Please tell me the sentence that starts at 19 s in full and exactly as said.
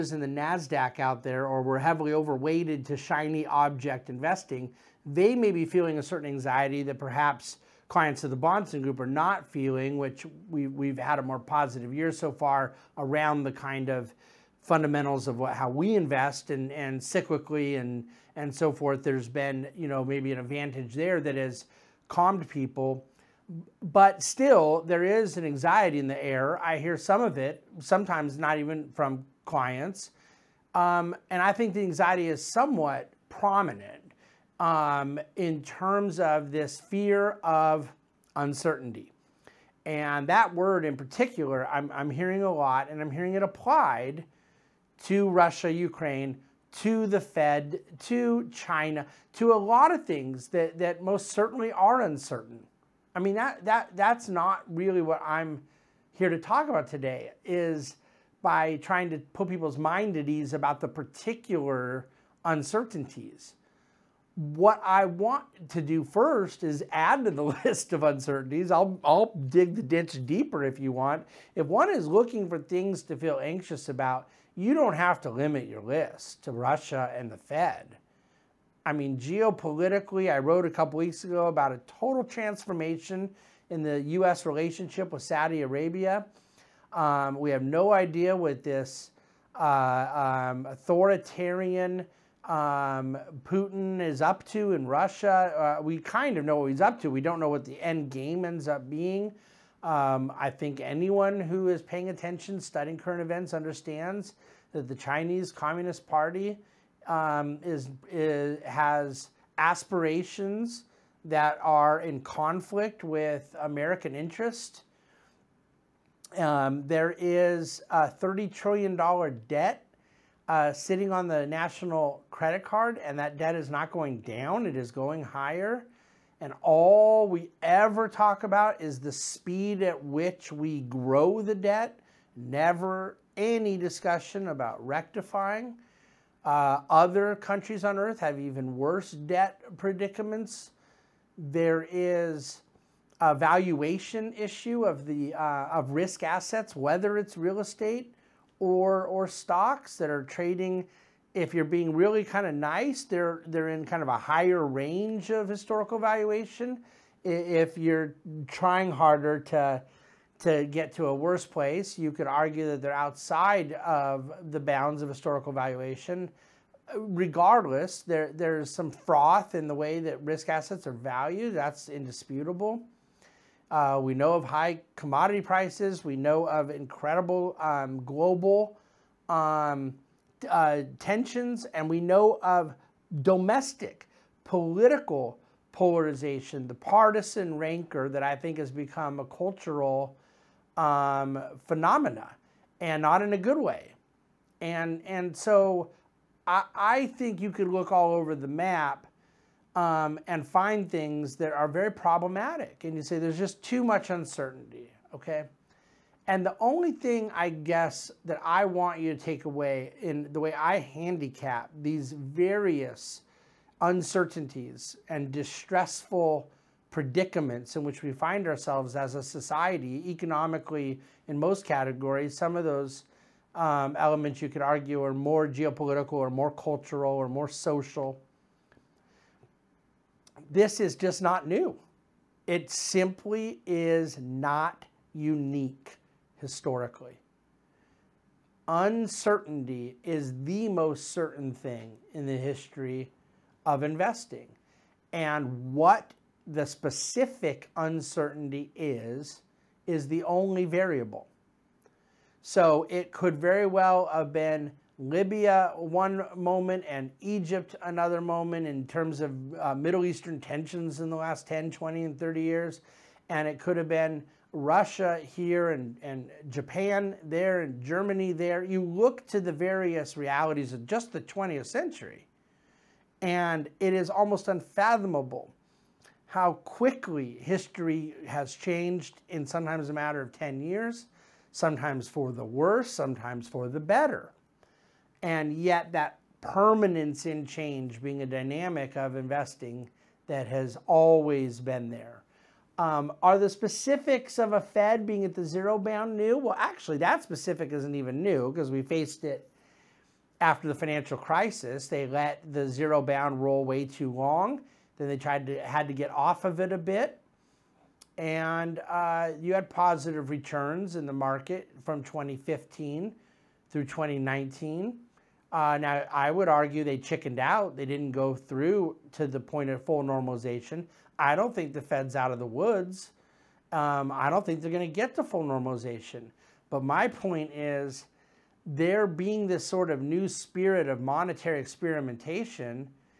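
There's been, you know, maybe an advantage there that has calmed people but still, there is an anxiety in the air.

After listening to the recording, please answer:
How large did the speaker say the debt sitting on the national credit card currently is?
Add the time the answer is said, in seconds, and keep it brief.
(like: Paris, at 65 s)
$30 trillion, at 118 s.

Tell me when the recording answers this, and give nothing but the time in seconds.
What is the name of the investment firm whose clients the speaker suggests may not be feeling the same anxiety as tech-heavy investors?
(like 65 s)
8 s.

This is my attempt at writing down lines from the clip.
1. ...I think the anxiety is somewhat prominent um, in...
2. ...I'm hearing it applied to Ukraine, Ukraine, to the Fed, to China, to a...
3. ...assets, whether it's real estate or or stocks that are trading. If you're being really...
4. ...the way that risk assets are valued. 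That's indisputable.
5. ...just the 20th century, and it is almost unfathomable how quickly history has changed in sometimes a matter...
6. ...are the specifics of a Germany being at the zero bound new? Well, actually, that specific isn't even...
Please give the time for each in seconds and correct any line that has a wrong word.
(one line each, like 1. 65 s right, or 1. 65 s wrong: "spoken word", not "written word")
1. 31 s right
2. 43 s wrong: "Russia", not "Ukraine"
3. 146 s right
4. 169 s right
5. 270 s right
6. 293 s wrong: "Fed", not "Germany".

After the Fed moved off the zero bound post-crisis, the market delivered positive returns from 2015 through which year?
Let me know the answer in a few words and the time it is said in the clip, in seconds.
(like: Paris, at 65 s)
2019, at 313 s.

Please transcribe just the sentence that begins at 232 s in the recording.
It simply is not unique historically.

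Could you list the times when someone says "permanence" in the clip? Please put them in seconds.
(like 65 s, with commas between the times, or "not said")
286 s.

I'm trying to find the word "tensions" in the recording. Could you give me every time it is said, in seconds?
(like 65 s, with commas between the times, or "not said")
180 s, 260 s.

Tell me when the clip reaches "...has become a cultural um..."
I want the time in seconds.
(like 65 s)
188 s.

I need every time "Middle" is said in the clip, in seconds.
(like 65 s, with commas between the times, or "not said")
259 s.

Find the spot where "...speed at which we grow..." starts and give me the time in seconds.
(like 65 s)
129 s.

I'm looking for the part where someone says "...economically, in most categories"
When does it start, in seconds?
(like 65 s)
220 s.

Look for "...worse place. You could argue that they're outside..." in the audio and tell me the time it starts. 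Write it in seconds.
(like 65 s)
161 s.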